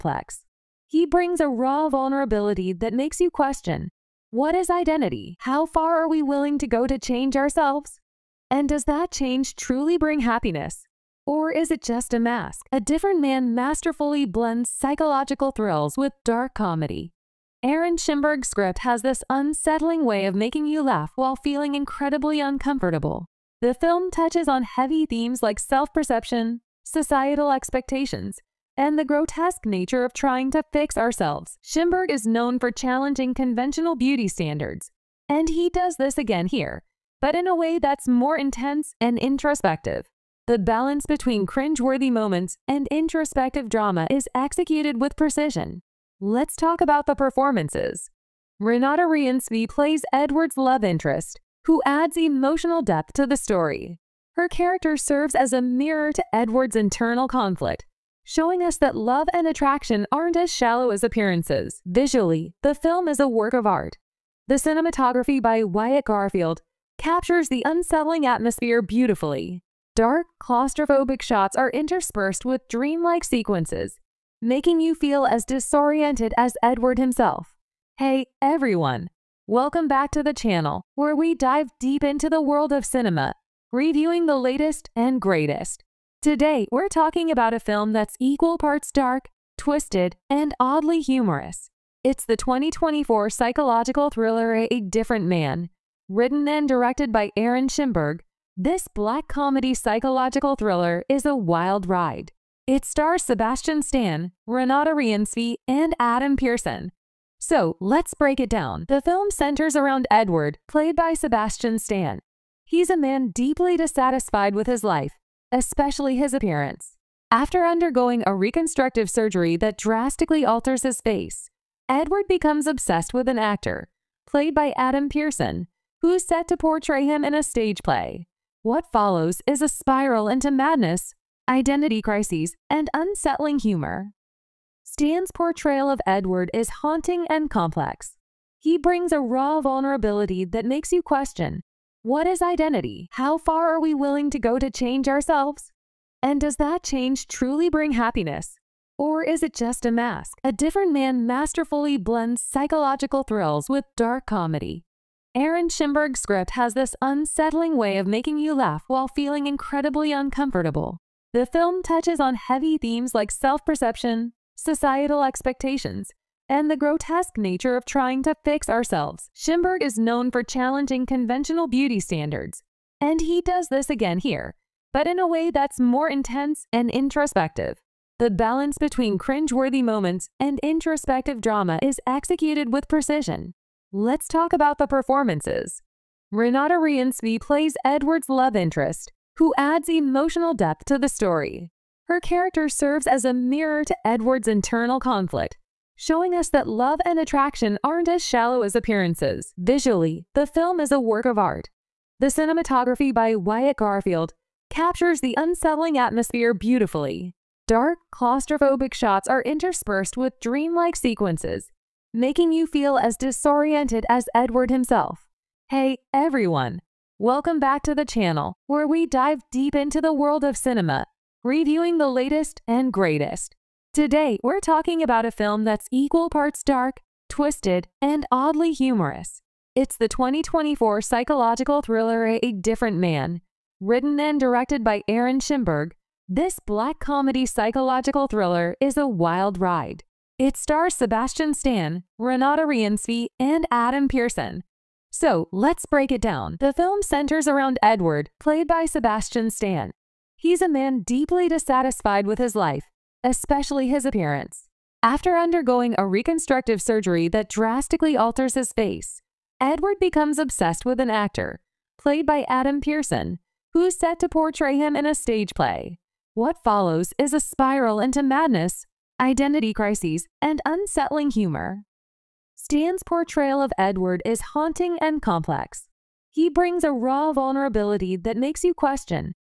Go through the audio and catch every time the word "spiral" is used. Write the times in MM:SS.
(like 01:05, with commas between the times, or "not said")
02:09, 04:27.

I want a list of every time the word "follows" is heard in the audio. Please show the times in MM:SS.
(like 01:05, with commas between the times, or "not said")
02:08, 04:26.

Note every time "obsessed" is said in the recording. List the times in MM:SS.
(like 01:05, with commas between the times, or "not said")
02:02, 04:20.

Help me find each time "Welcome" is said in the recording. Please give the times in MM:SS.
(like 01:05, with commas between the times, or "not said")
01:19, 03:37.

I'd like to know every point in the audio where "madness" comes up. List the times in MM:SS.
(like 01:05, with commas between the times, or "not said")
02:10, 04:28.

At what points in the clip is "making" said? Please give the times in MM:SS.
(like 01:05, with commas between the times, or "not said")
00:20, 01:14, 02:38, 03:32.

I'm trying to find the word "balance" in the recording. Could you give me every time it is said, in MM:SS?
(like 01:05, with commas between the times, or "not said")
00:40, 02:58.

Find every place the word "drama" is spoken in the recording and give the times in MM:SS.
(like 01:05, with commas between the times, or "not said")
00:43, 03:01.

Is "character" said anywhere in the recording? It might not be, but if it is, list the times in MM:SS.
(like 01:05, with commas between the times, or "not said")
00:54, 03:12.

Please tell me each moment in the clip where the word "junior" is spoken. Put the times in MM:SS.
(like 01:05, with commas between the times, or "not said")
not said.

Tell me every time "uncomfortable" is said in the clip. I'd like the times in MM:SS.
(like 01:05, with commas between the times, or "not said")
00:22, 02:40.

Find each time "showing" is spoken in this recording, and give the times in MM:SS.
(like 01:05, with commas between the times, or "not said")
00:58, 03:15.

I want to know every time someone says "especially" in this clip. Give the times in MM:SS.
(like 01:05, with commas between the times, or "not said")
01:55, 04:13.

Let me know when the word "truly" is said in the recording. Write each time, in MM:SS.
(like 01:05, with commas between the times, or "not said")
00:09, 02:27.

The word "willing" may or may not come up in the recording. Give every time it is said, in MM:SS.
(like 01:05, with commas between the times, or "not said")
00:06, 02:23.